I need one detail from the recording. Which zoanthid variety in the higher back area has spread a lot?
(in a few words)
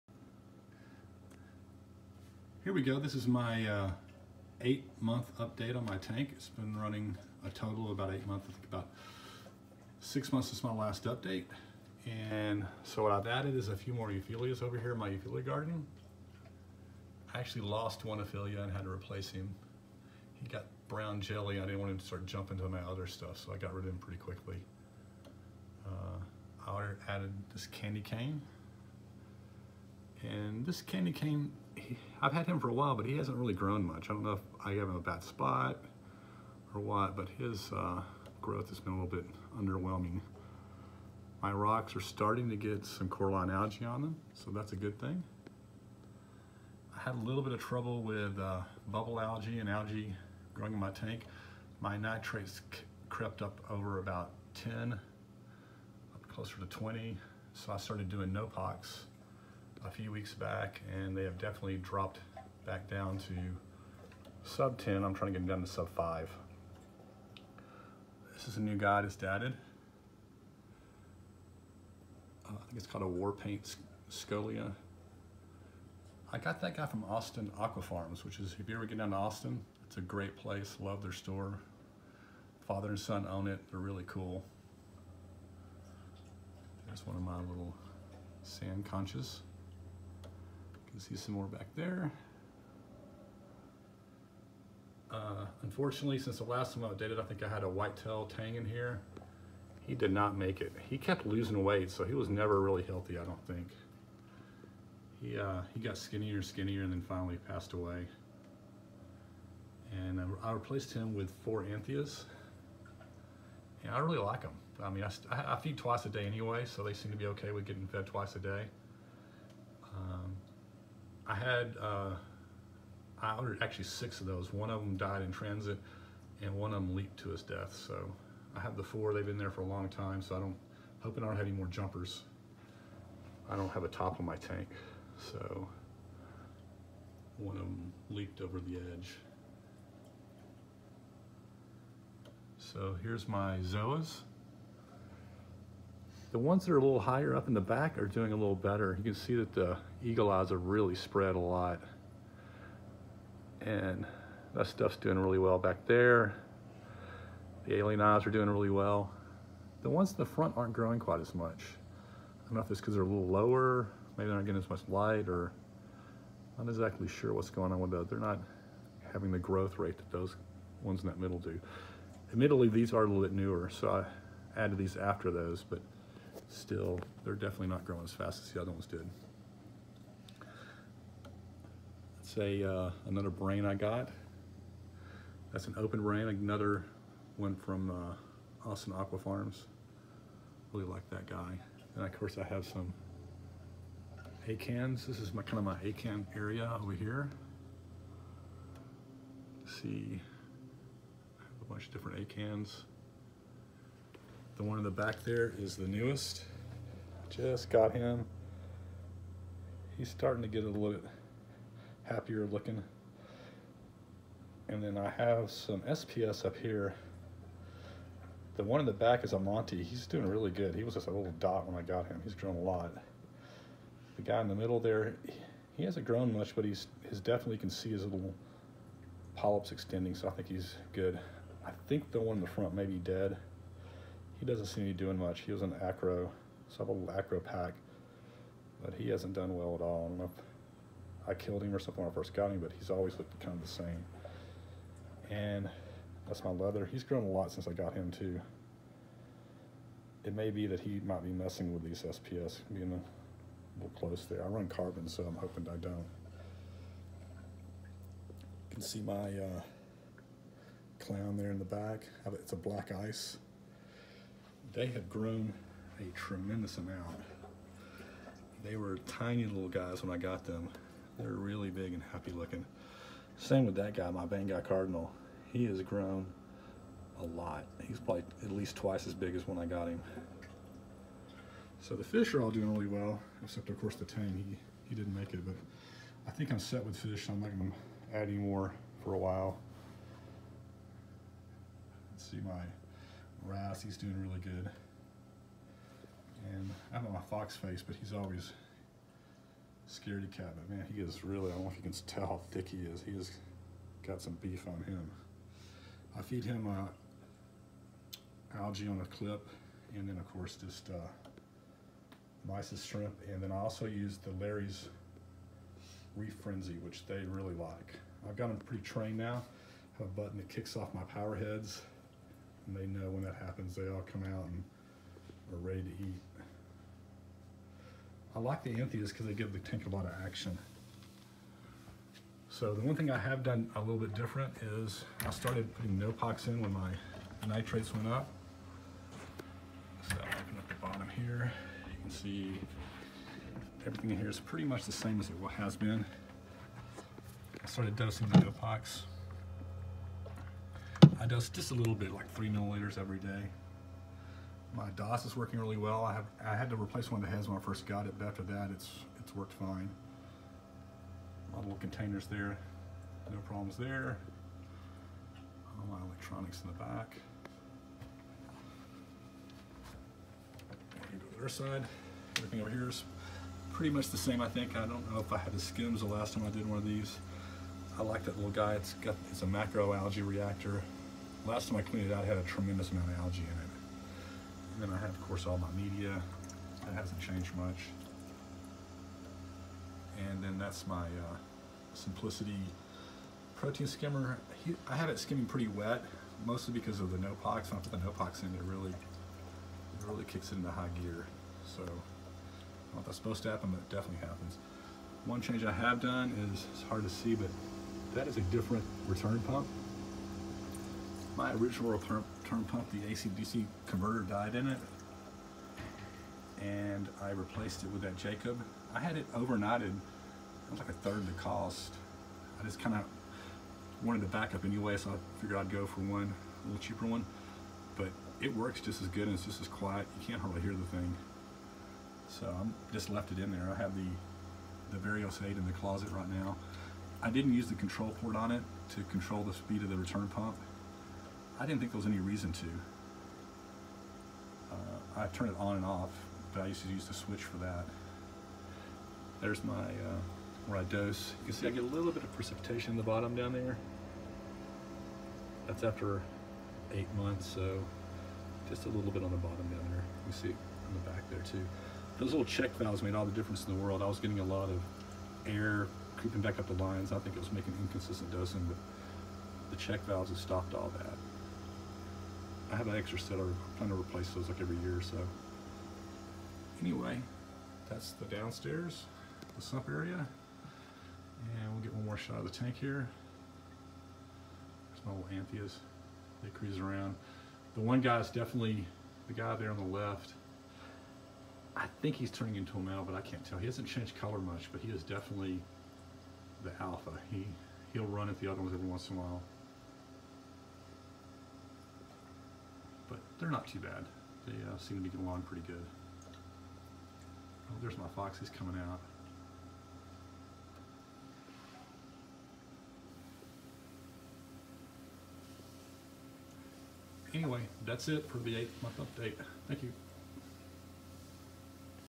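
eagle eyes.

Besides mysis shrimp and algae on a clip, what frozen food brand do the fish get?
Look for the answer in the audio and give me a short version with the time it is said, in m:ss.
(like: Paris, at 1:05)
Larry's Reef Frenzy, at 5:14.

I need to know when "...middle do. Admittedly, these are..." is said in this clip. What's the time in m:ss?
2:51.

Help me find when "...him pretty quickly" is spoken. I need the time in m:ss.
0:23.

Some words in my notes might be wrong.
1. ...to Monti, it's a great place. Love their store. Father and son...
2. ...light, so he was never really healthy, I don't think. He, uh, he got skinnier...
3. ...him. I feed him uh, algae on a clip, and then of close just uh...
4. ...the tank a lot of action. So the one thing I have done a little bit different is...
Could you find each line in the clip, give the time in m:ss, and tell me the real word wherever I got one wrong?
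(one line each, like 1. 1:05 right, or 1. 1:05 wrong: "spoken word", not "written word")
1. 1:19 wrong: "Austin", not "Monti"
2. 1:41 wrong: "weight", not "light"
3. 5:04 wrong: "course", not "close"
4. 5:29 right.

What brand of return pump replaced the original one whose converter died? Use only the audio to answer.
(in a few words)
Jebao.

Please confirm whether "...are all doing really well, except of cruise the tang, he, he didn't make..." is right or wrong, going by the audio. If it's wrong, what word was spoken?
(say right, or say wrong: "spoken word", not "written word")
wrong: "course", not "cruise".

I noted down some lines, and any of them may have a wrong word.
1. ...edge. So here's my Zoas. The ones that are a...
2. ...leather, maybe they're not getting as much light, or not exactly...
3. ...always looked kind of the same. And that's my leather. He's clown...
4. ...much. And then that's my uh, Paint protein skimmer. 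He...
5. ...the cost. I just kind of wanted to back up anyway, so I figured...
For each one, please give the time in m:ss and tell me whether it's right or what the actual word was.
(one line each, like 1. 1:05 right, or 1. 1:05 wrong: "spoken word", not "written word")
1. 2:18 right
2. 2:43 wrong: "lower", not "leather"
3. 4:02 wrong: "grown", not "clown"
4. 6:27 wrong: "Simplicity", not "Paint"
5. 7:01 right.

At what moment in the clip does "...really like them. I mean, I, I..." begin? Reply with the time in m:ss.
1:53.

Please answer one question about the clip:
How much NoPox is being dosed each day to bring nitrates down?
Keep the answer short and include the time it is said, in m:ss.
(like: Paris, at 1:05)
3 milliliters, at 5:52.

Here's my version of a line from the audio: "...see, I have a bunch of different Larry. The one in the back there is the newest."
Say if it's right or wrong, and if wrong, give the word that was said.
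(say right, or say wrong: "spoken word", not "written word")
wrong: "Acans", not "Larry".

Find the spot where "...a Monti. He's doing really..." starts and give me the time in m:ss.
3:39.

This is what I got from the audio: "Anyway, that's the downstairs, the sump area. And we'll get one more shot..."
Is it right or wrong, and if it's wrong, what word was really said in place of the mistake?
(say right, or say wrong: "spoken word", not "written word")
right.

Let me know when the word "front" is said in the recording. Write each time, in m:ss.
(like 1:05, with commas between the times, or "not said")
2:40, 3:52.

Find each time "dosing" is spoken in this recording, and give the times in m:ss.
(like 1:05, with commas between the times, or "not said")
5:47, 7:48.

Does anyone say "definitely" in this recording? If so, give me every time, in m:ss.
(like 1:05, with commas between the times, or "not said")
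1:01, 2:57, 3:47, 6:43, 8:08, 8:15.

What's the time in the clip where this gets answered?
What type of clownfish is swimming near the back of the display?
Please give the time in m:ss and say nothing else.
4:22.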